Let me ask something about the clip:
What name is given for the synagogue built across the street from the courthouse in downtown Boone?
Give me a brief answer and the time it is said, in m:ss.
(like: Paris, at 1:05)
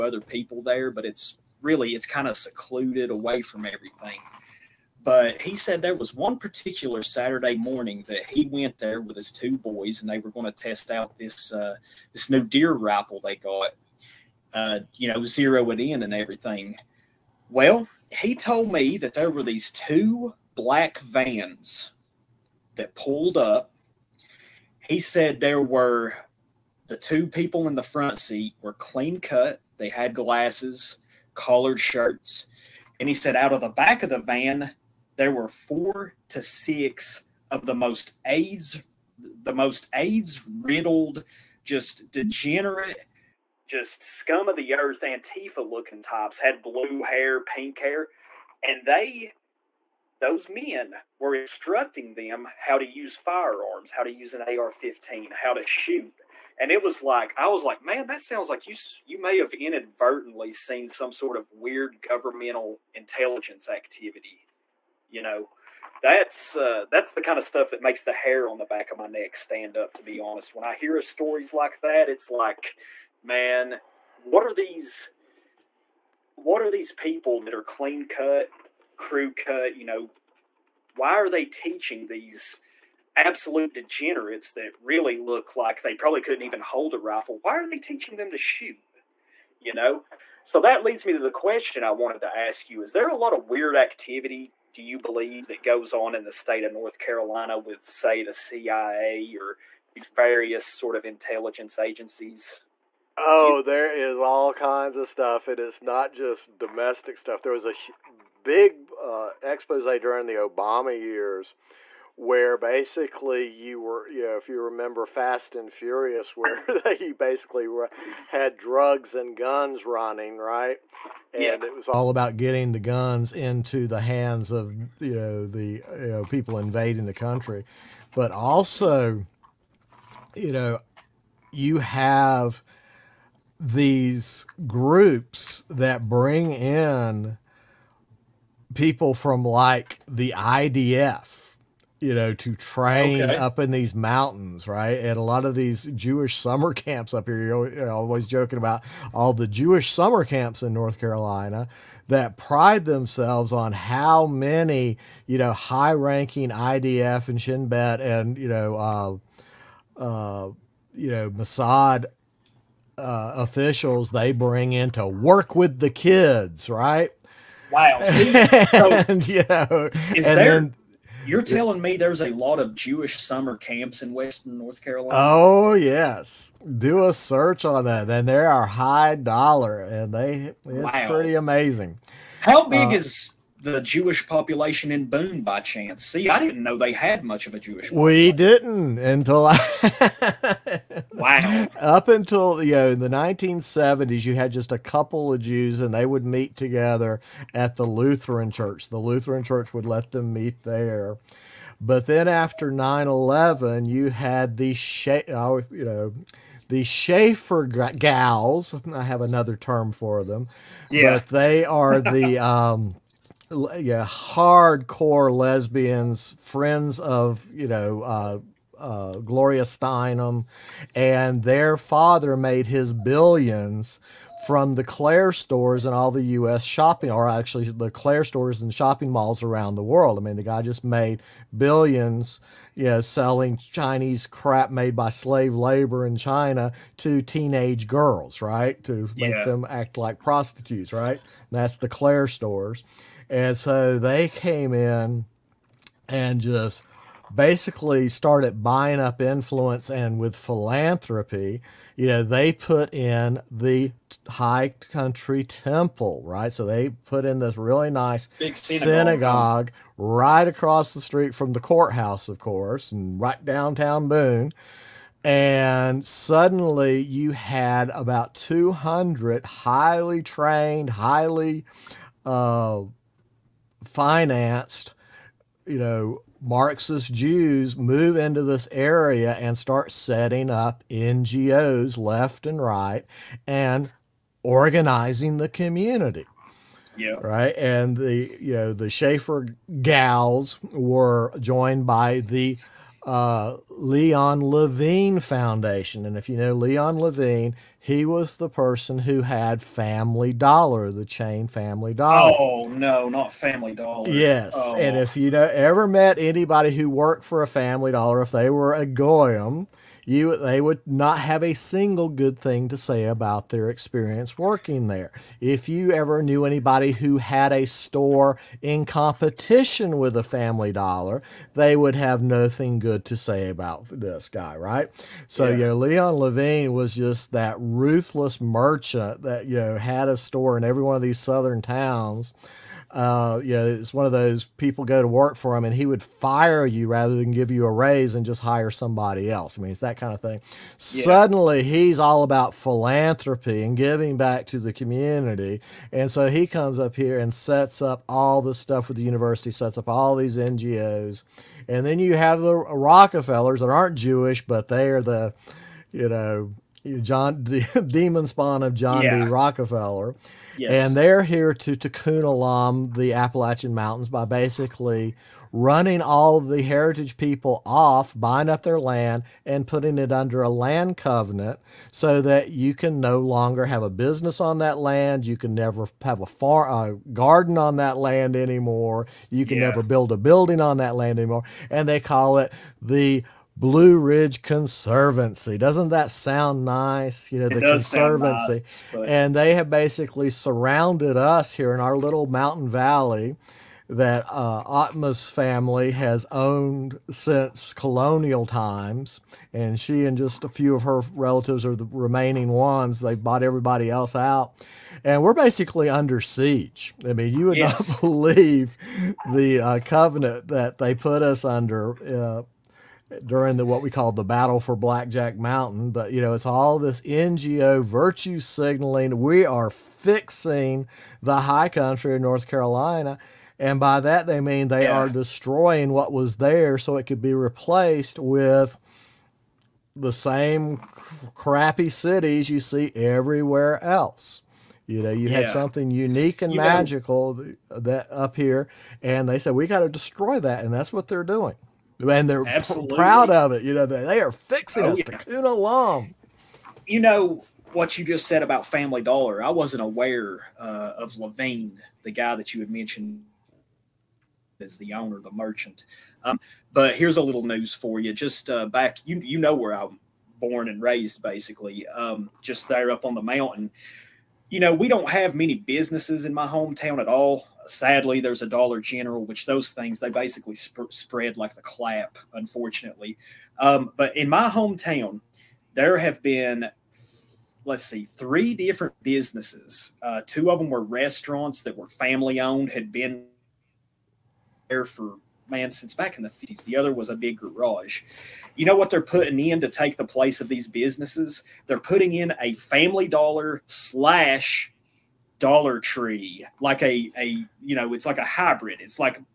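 High Country Temple, at 4:14.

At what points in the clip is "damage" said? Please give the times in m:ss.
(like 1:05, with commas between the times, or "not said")
not said.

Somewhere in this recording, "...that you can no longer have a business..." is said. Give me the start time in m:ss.
6:12.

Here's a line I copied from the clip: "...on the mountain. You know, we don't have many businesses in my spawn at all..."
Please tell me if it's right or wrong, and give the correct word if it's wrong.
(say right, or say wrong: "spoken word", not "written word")
wrong: "hometown", not "spawn".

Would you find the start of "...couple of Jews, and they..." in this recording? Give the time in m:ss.
3:14.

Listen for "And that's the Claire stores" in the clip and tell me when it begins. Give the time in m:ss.
4:01.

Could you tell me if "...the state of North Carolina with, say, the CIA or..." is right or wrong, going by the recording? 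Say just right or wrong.
right.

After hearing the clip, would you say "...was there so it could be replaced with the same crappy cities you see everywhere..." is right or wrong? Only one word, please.
right.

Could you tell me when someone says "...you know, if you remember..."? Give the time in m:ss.
1:54.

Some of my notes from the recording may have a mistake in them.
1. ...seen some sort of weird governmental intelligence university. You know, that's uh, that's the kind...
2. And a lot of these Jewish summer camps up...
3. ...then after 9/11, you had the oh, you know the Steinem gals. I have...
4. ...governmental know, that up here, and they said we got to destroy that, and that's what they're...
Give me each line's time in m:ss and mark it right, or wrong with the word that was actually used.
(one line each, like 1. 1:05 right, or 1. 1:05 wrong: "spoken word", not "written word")
1. 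1:00 wrong: "activity", not "university"
2. 2:24 right
3. 3:22 wrong: "Schaefer", not "Steinem"
4. 7:16 wrong: "magical", not "governmental".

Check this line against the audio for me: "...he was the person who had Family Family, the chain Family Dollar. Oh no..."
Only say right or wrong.
wrong.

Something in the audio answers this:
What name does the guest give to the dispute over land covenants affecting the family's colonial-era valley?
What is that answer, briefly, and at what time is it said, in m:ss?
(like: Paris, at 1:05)
battle for Blackjack Mountain, at 6:54.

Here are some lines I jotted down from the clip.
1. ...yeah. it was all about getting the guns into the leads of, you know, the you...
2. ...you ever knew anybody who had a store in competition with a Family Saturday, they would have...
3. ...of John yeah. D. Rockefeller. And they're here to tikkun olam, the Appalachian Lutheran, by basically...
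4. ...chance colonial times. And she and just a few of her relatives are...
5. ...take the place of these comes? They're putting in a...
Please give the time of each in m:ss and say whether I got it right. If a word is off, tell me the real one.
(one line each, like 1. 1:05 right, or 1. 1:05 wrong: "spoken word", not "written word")
1. 2:01 wrong: "hands", not "leads"
2. 5:15 wrong: "Dollar", not "Saturday"
3. 5:58 wrong: "Mountains", not "Lutheran"
4. 6:37 wrong: "since", not "chance"
5. 8:09 wrong: "businesses", not "comes".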